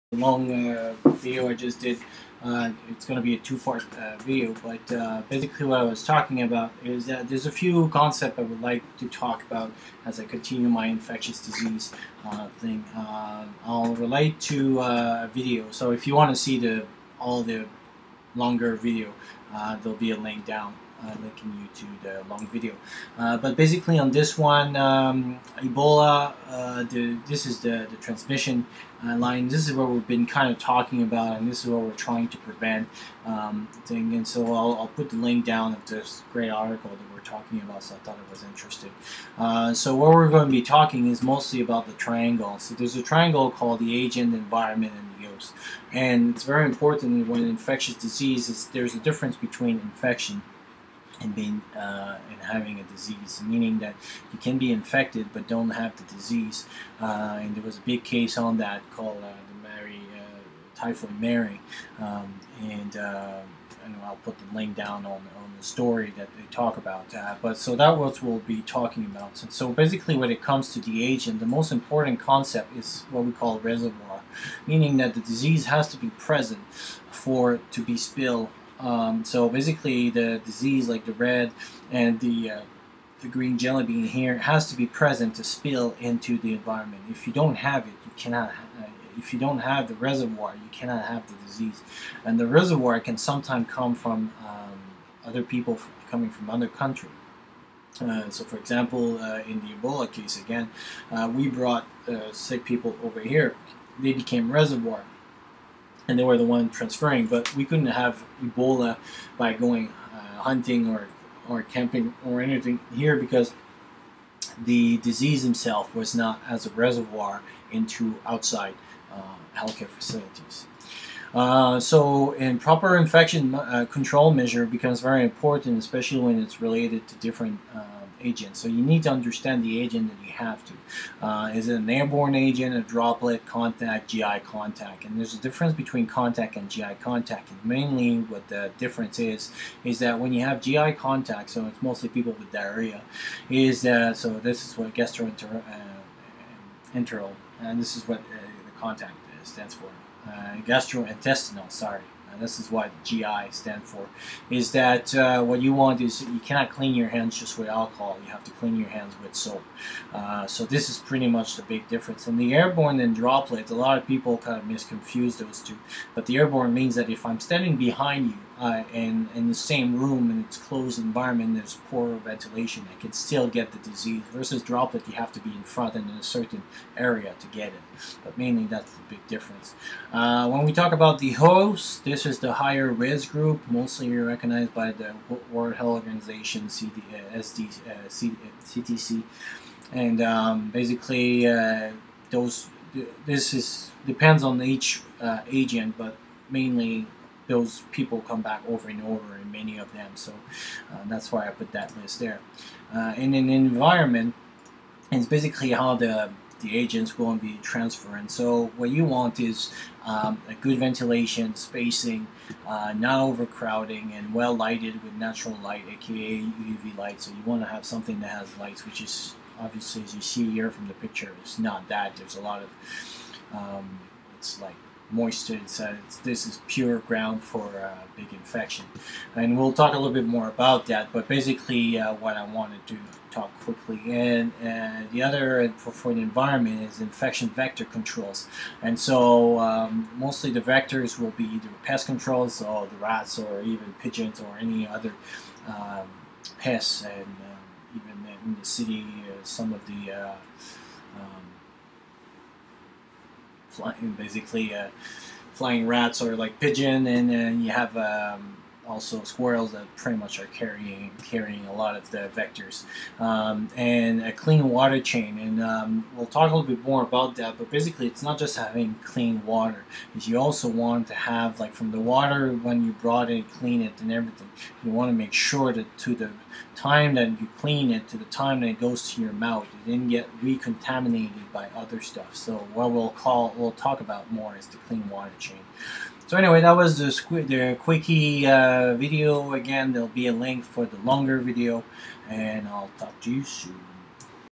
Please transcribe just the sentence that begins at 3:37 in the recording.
So you want to have something that has lights, which is obviously, as you see here from the picture, it's not that.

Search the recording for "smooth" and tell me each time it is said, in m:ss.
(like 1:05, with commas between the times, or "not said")
not said.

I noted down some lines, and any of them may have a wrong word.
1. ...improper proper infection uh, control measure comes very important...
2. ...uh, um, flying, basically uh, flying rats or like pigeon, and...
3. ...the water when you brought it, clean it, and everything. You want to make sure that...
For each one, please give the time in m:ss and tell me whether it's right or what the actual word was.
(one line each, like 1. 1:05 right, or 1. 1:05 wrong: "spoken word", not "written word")
1. 2:02 wrong: "becomes", not "comes"
2. 4:10 right
3. 4:31 right.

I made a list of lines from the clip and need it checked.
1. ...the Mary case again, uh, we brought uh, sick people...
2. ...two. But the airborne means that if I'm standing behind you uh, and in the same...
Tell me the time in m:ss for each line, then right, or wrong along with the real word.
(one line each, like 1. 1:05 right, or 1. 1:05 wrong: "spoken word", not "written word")
1. 1:39 wrong: "Ebola", not "Mary"
2. 2:45 right.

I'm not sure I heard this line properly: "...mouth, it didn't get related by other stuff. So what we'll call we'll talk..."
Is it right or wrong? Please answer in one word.
wrong.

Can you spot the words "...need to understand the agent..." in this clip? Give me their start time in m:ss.
2:08.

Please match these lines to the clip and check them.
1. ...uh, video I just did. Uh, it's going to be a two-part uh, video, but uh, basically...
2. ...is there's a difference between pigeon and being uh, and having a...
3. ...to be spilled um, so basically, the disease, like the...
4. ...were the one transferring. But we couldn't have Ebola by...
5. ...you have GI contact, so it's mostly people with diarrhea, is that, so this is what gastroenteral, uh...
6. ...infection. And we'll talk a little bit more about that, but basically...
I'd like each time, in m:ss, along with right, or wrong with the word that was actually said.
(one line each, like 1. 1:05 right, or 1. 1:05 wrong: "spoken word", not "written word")
1. 0:00 right
2. 0:48 wrong: "infection", not "pigeon"
3. 1:17 right
4. 1:46 right
5. 2:20 right
6. 3:48 right.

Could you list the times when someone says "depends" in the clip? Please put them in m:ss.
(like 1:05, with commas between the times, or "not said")
3:14.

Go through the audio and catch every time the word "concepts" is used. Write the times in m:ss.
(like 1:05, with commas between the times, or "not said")
0:07, 1:12.